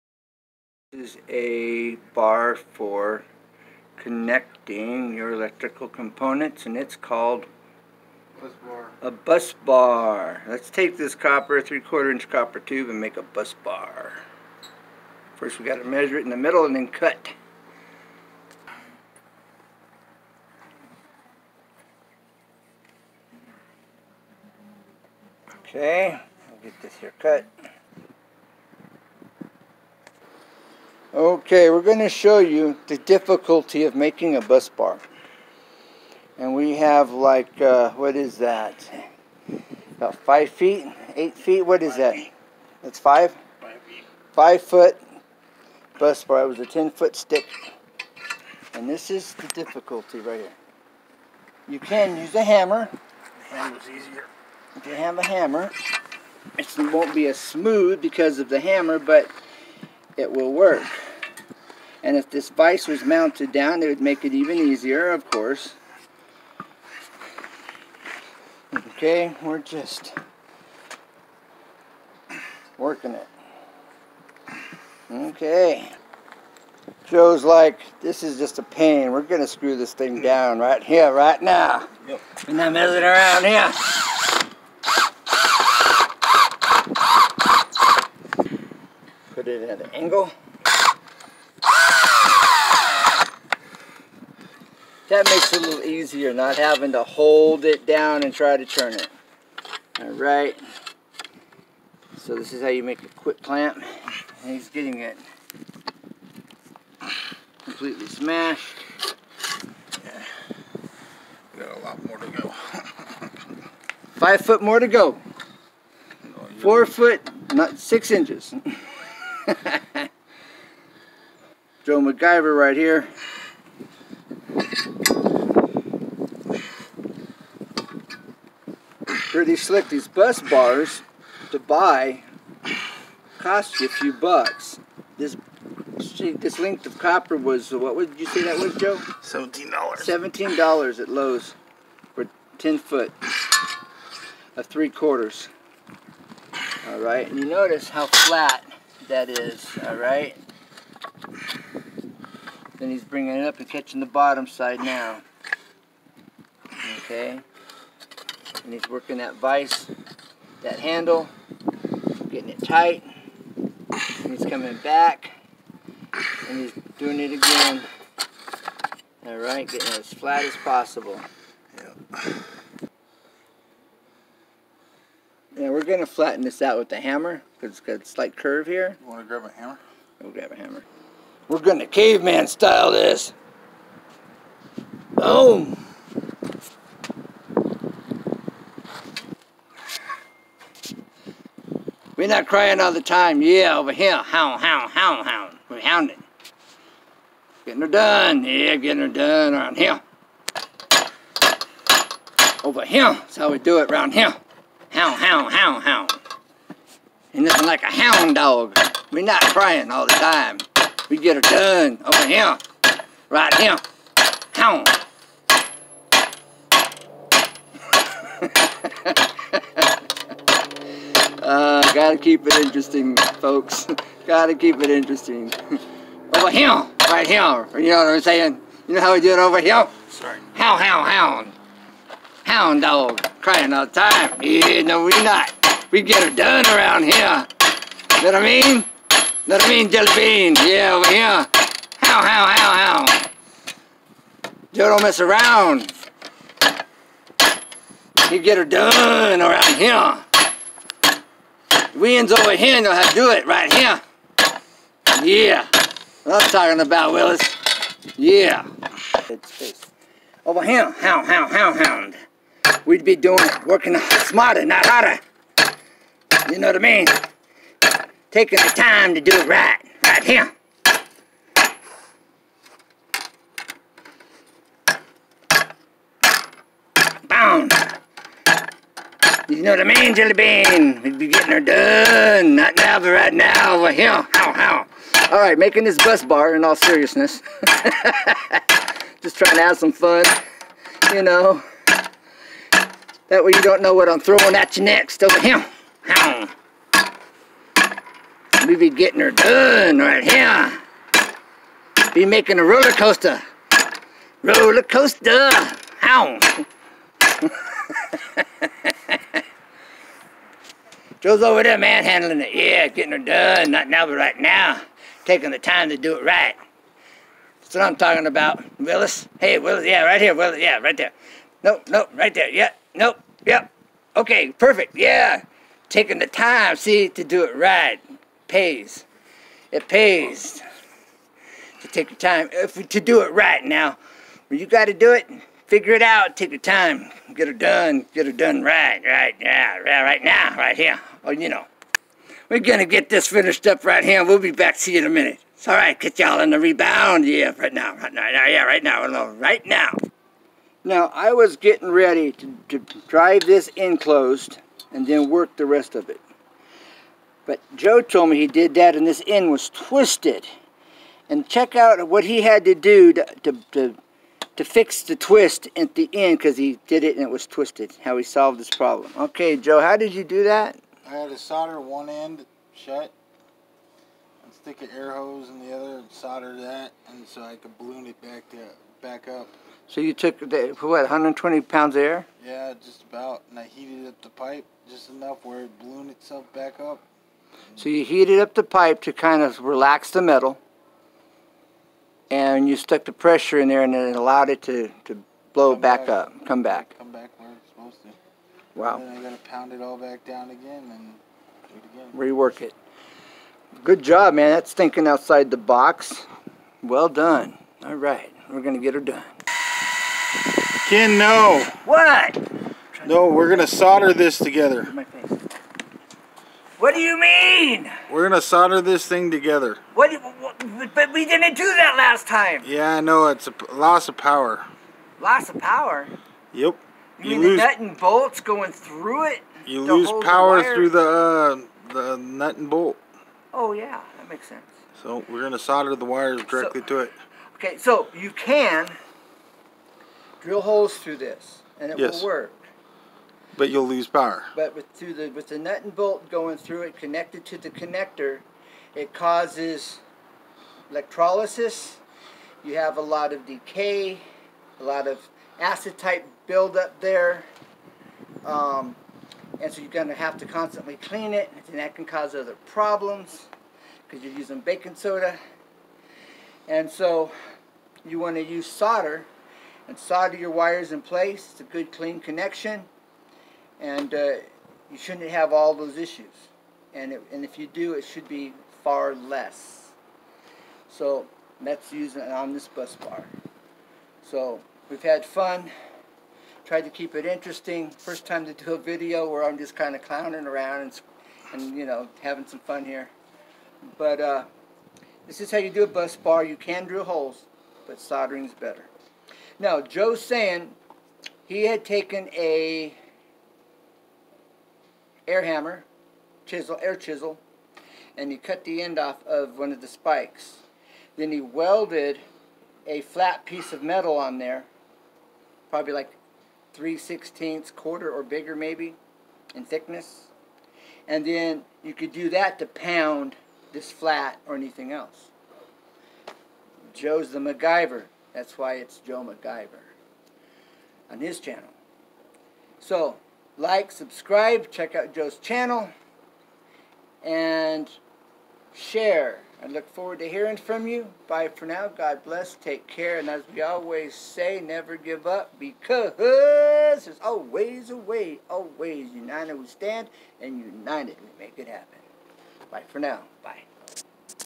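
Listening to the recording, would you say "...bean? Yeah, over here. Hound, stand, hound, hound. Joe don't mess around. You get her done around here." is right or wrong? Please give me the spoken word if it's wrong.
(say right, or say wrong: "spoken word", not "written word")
wrong: "hound", not "stand".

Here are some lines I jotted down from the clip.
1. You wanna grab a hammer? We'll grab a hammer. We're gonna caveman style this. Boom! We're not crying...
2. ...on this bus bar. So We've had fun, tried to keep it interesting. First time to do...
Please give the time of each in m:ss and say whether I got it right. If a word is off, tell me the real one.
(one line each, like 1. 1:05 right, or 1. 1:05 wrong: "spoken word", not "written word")
1. 2:59 right
2. 8:02 right.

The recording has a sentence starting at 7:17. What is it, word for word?
Okay, so you can drill holes through this, and it yes.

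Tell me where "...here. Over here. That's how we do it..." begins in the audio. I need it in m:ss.
3:19.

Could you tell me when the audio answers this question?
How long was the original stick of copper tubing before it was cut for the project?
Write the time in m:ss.
0:46.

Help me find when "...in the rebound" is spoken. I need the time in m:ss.
5:46.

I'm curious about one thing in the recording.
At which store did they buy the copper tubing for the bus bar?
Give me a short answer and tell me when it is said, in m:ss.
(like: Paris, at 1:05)
Lowe's, at 2:21.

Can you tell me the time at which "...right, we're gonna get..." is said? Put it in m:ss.
6:47.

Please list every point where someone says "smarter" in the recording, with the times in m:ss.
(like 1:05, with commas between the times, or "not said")
4:24.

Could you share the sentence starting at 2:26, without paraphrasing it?
All right, and you notice how flat that is.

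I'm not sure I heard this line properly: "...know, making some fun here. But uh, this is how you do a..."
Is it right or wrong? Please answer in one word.
wrong.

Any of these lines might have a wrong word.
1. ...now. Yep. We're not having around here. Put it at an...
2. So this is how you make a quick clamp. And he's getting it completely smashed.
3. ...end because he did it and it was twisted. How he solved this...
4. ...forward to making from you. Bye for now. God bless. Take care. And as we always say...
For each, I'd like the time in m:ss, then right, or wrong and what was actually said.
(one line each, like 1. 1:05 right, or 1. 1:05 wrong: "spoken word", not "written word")
1. 1:21 wrong: "messing", not "having"
2. 1:42 right
3. 6:06 right
4. 8:59 wrong: "hearing", not "making".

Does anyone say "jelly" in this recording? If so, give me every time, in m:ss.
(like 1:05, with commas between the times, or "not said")
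3:59, 4:40.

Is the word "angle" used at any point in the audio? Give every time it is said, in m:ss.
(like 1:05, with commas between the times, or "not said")
1:29.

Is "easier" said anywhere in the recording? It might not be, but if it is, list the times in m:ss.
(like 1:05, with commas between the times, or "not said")
0:53, 1:04, 1:35.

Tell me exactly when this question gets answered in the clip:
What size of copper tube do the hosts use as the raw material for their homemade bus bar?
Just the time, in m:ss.
0:11.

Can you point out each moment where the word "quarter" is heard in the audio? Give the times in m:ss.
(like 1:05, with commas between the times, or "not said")
0:11, 2:24, 8:37.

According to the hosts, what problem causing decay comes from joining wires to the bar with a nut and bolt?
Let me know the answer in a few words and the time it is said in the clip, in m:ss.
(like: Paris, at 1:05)
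electrolysis, at 7:30.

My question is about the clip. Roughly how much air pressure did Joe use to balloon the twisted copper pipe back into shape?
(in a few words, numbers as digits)
120 pounds.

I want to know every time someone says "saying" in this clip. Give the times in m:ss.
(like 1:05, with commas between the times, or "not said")
3:48, 8:20.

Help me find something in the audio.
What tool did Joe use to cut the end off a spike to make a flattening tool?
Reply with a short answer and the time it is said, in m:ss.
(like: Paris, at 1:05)
air chisel, at 8:26.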